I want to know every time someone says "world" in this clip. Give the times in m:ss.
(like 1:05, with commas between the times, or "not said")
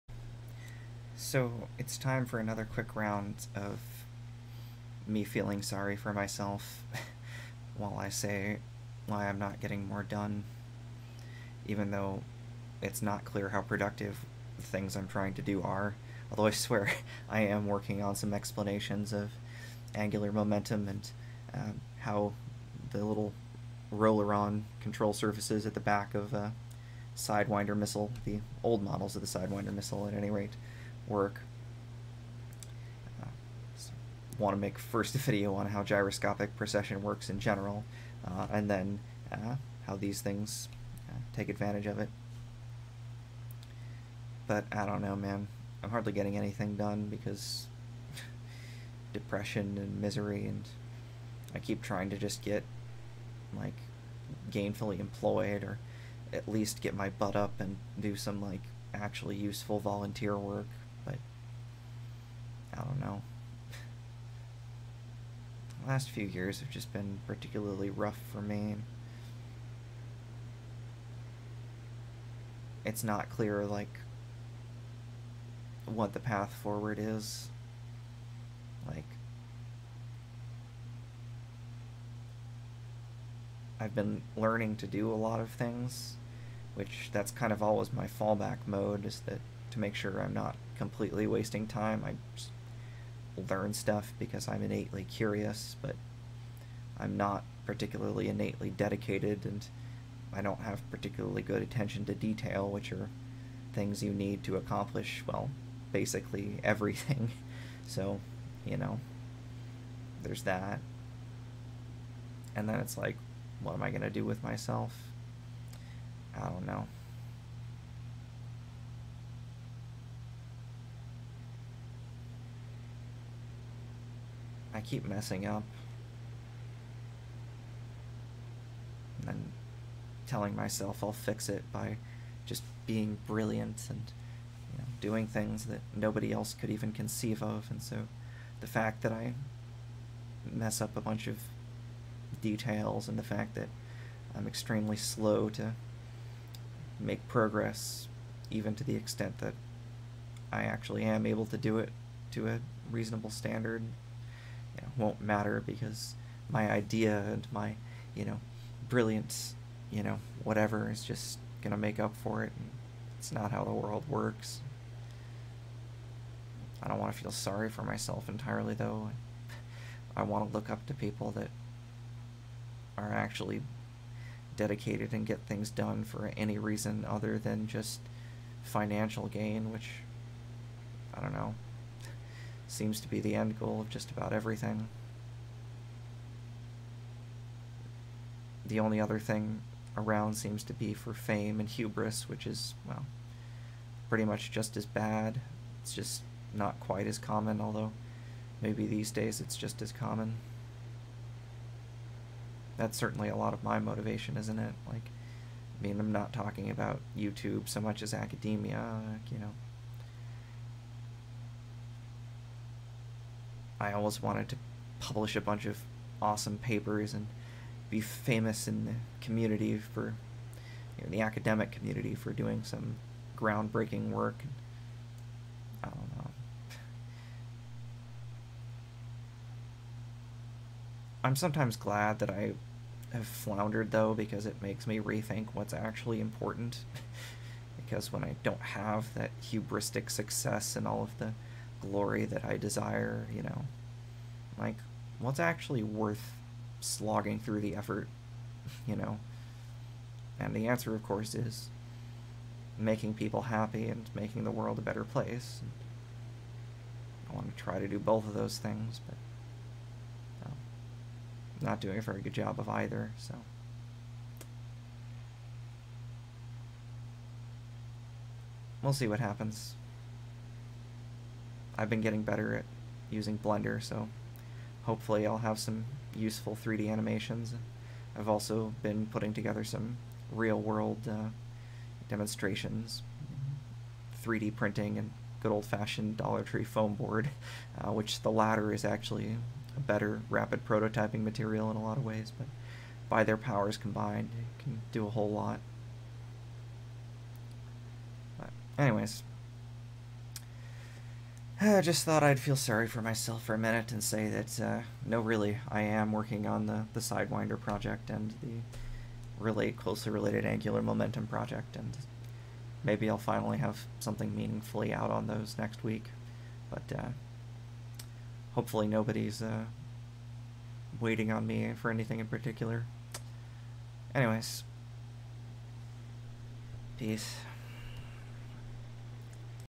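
2:43, 4:14, 4:40.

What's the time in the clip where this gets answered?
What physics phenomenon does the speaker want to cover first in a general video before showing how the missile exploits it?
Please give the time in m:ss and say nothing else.
0:35.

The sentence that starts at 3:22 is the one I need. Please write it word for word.
That's certainly a lot of my motivation, isn't it?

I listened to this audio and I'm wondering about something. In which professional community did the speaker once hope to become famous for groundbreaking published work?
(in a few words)
Academia.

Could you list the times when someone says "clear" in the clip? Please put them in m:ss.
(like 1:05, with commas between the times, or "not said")
0:13, 1:13.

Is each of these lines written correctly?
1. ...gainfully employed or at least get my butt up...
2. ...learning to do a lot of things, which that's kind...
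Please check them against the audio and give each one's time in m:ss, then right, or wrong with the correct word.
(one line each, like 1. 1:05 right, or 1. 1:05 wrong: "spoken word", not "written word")
1. 0:54 right
2. 1:24 right.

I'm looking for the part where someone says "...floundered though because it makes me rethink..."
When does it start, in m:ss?
3:53.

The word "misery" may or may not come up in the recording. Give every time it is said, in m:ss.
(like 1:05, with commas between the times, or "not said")
0:50.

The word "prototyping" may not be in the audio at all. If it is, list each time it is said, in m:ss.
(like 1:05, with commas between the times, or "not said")
4:50.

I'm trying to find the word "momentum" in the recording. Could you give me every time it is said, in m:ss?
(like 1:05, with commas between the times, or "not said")
0:20, 5:10.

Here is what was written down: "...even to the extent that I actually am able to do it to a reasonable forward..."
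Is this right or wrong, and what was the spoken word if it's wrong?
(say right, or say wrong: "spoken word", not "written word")
wrong: "standard", not "forward".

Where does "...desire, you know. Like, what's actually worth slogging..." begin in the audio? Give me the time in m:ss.
4:02.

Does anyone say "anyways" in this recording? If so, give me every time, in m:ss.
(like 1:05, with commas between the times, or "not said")
4:58, 5:24.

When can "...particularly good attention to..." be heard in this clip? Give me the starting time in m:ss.
1:40.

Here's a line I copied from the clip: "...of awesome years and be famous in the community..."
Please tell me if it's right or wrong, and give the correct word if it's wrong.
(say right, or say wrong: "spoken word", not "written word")
wrong: "papers", not "years".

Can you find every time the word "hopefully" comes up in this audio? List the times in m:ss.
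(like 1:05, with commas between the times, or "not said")
4:34, 5:18.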